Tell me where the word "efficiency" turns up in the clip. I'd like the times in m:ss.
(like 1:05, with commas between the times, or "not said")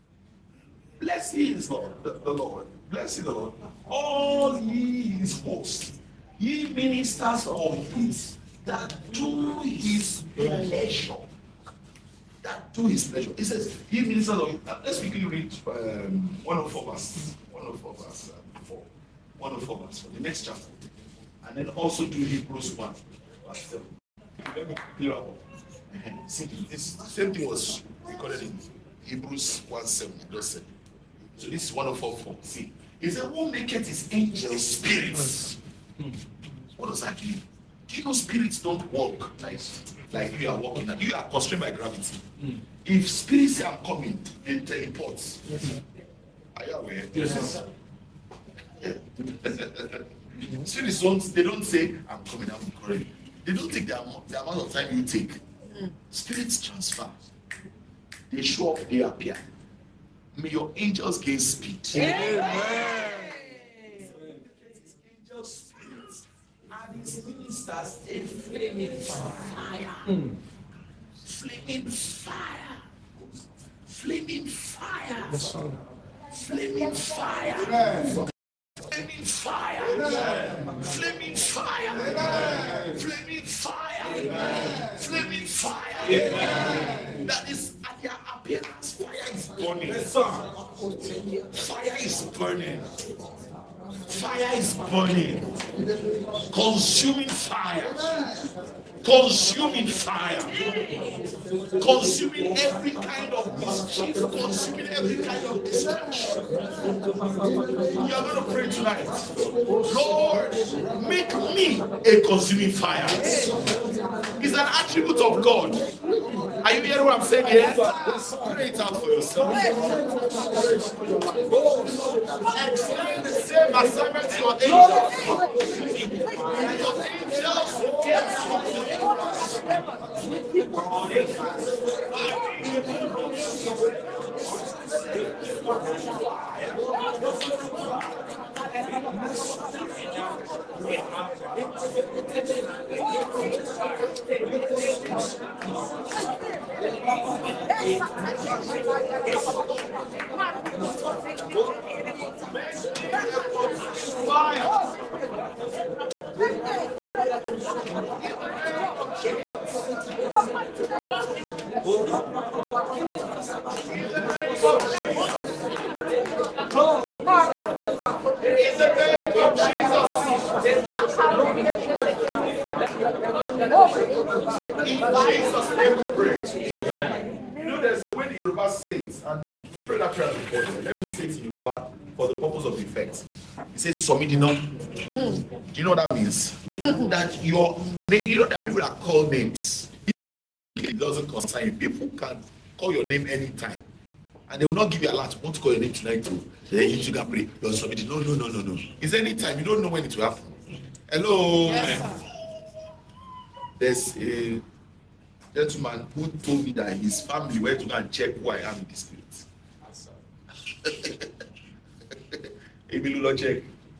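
not said.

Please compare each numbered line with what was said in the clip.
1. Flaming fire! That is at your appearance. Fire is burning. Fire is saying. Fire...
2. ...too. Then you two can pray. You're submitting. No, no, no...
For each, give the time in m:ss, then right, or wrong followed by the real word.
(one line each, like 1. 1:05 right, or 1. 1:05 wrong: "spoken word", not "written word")
1. 1:24 wrong: "burning", not "saying"
2. 3:16 right.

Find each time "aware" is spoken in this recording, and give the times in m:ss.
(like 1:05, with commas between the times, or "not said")
0:46.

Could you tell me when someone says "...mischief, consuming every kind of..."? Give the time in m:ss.
1:43.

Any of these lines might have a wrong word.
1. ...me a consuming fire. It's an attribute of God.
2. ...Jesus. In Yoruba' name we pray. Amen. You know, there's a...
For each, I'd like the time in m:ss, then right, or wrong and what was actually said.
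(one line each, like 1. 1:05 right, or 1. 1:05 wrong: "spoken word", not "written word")
1. 1:51 right
2. 2:49 wrong: "Jesus", not "Yoruba".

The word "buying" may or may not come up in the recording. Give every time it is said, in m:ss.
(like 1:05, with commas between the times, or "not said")
not said.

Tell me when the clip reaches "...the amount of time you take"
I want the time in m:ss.
0:54.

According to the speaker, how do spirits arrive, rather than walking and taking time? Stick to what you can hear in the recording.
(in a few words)
Teleport.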